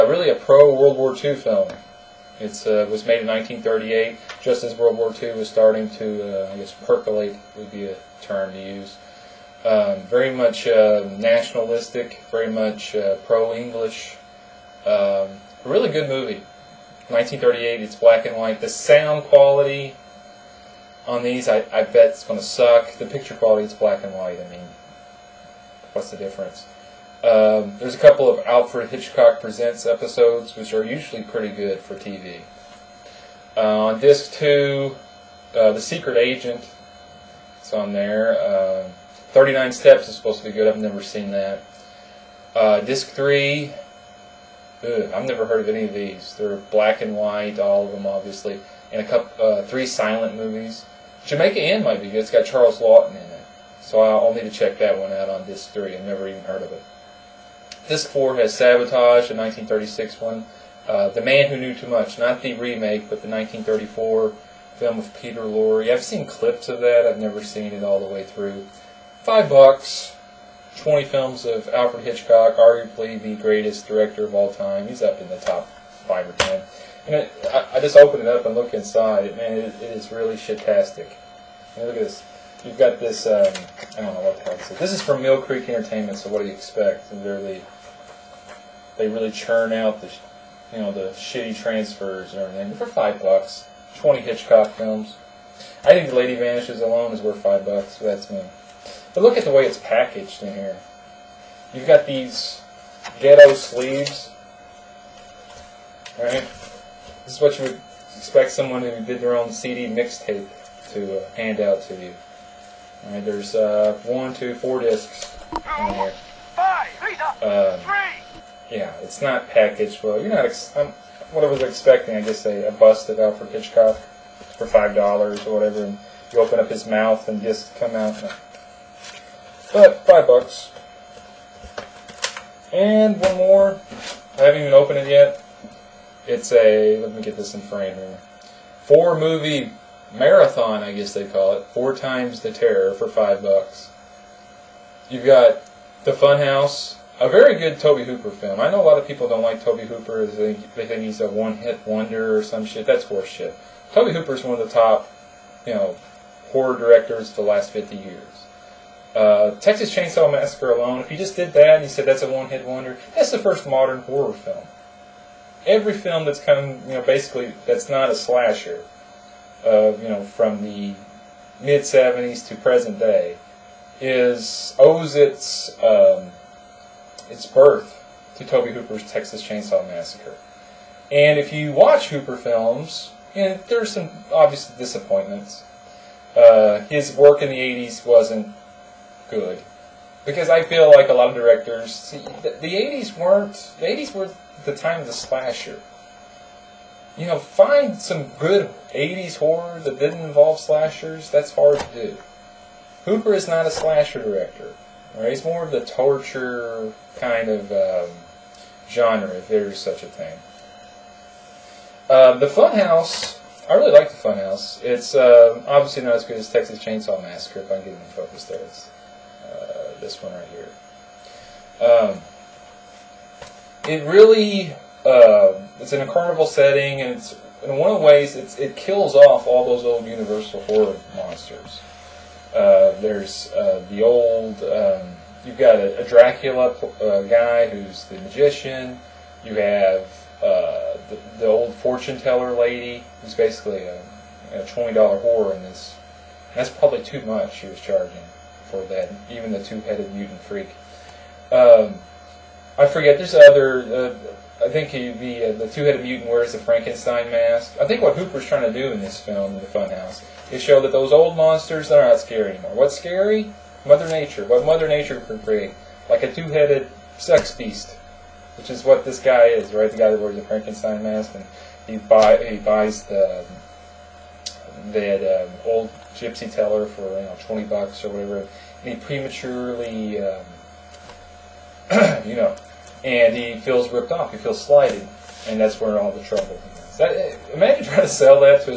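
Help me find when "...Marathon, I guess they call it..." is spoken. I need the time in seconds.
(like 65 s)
140 s.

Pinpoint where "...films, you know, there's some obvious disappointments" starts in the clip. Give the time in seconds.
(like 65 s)
182 s.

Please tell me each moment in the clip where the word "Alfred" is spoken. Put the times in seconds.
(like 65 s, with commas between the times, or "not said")
28 s, 71 s, 123 s.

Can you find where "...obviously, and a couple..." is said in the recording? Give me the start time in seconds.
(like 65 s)
48 s.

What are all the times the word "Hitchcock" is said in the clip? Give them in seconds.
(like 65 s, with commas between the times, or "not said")
28 s, 72 s, 94 s, 123 s.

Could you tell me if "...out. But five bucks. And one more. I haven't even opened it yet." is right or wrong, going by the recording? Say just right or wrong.
right.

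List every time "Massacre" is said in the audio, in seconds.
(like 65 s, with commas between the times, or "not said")
160 s, 179 s, 217 s.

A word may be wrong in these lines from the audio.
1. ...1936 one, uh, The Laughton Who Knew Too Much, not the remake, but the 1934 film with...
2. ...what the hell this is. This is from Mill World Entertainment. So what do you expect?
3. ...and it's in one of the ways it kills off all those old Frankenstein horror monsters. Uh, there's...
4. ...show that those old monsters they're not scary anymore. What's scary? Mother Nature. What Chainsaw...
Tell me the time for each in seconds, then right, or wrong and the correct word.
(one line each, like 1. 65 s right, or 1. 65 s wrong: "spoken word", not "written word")
1. 59 s wrong: "Man", not "Laughton"
2. 84 s wrong: "Creek", not "World"
3. 227 s wrong: "Universal", not "Frankenstein"
4. 260 s wrong: "Mother", not "Chainsaw".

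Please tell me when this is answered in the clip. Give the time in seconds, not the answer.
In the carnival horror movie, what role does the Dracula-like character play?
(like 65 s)
238 s.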